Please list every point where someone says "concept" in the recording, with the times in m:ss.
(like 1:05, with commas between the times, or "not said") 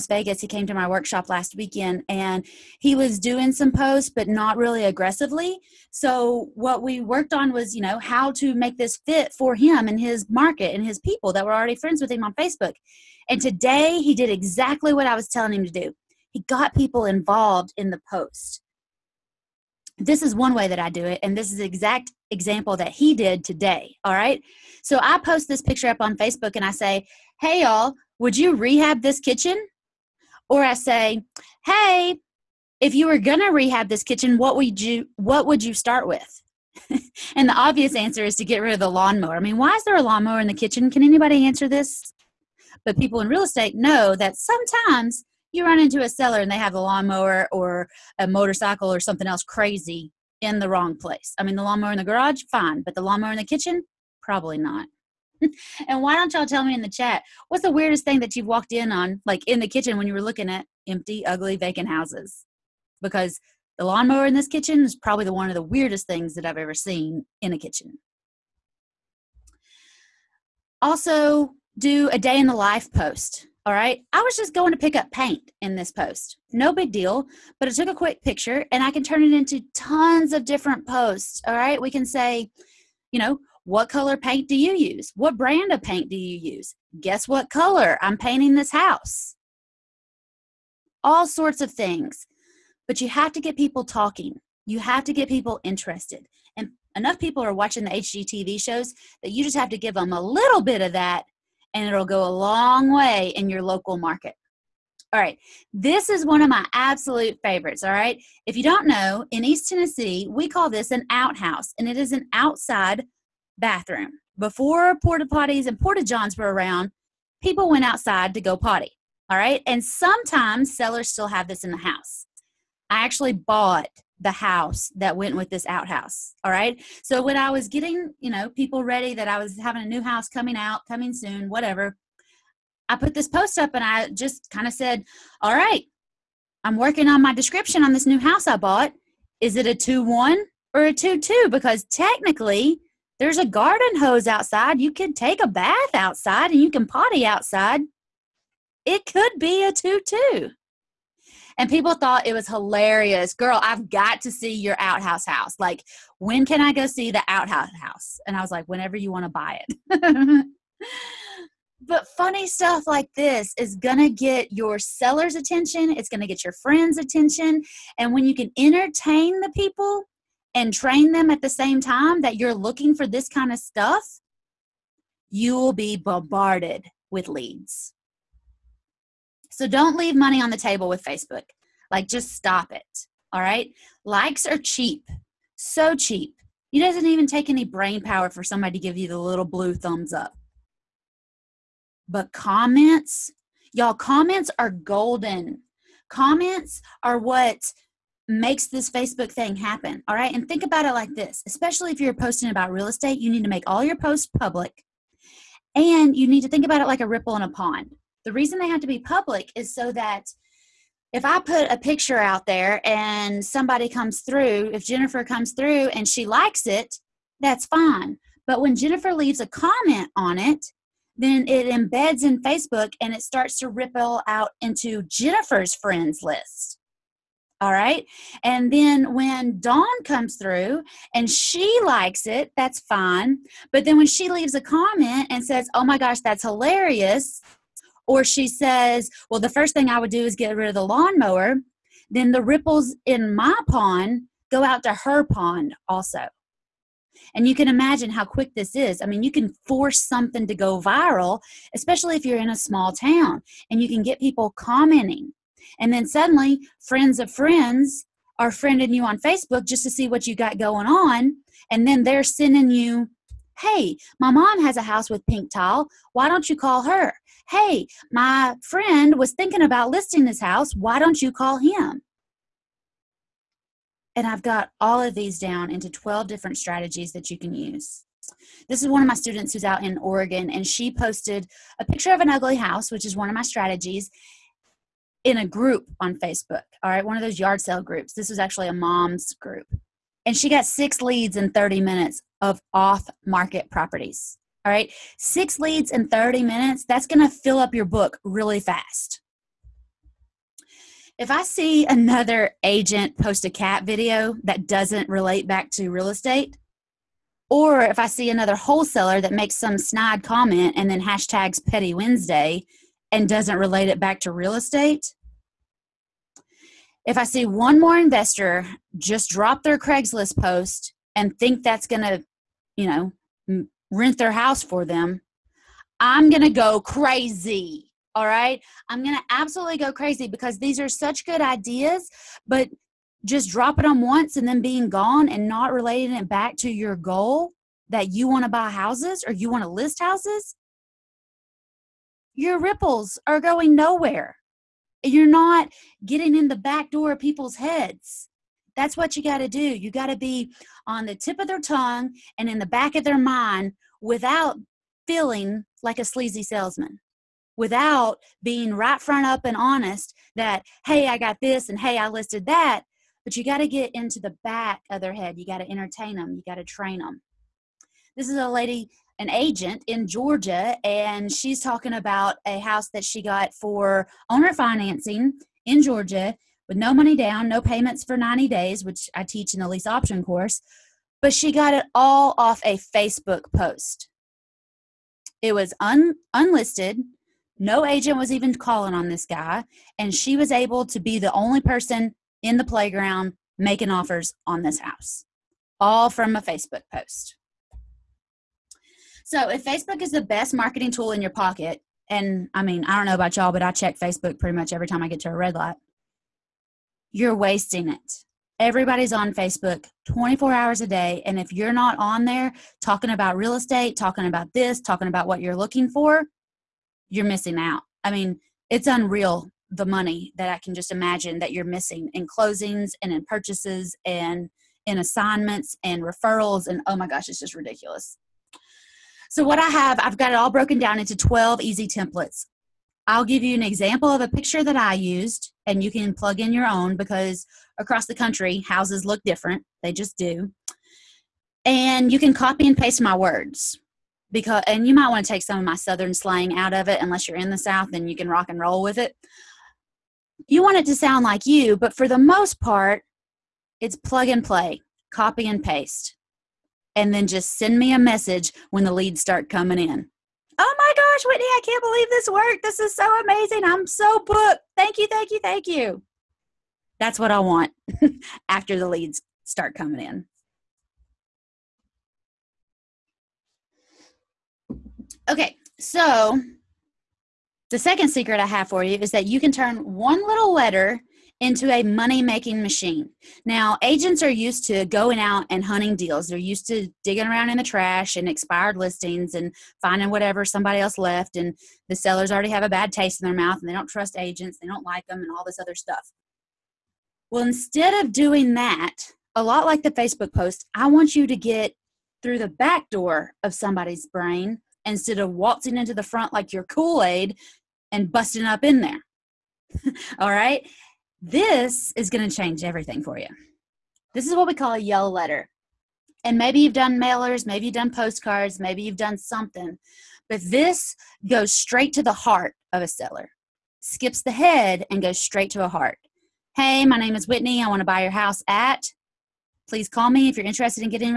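not said.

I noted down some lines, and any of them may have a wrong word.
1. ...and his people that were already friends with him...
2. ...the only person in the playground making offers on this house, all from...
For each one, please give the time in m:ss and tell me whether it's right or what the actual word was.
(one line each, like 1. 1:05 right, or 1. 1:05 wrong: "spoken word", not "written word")
1. 0:10 right
2. 6:31 right.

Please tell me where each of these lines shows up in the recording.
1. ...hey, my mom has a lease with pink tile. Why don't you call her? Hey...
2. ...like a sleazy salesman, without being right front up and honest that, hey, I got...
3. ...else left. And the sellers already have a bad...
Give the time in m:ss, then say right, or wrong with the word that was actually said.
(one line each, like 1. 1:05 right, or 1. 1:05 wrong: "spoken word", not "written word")
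1. 4:23 wrong: "house", not "lease"
2. 5:55 right
3. 8:10 right.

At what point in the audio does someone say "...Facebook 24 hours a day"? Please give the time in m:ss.
6:49.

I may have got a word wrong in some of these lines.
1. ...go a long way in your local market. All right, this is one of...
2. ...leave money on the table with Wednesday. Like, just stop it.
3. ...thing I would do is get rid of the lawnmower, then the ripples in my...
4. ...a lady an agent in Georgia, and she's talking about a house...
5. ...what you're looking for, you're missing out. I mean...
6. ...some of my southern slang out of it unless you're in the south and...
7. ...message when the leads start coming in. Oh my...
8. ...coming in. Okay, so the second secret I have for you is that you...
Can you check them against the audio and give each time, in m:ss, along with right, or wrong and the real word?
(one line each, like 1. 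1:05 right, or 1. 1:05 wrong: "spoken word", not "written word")
1. 1:42 right
2. 2:59 wrong: "Facebook", not "Wednesday"
3. 3:59 right
4. 6:08 right
5. 6:55 right
6. 7:25 right
7. 7:37 right
8. 7:49 right.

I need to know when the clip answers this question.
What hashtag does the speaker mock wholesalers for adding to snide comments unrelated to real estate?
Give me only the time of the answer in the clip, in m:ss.
5:11.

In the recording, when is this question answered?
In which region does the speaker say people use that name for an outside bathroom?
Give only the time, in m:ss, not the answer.
1:49.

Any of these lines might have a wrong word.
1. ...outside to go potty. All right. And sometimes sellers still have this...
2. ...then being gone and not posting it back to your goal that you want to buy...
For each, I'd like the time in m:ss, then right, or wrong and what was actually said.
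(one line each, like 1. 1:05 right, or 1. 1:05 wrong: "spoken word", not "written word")
1. 1:57 right
2. 5:34 wrong: "relating", not "posting".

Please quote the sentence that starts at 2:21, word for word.
Because technically, there's a garden hose outside.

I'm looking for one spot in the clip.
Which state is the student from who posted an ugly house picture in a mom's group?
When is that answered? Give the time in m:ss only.
4:39.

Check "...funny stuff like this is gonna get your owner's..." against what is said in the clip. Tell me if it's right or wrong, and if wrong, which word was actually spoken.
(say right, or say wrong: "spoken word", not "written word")
wrong: "seller", not "owner".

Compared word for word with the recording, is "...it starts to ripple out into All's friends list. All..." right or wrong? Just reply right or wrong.
wrong.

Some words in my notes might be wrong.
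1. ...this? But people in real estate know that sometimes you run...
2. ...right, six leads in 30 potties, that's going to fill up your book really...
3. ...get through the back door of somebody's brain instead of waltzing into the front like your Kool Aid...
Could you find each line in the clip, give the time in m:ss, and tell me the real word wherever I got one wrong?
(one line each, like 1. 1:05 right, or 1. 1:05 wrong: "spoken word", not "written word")
1. 0:41 right
2. 4:54 wrong: "minutes", not "potties"
3. 8:21 right.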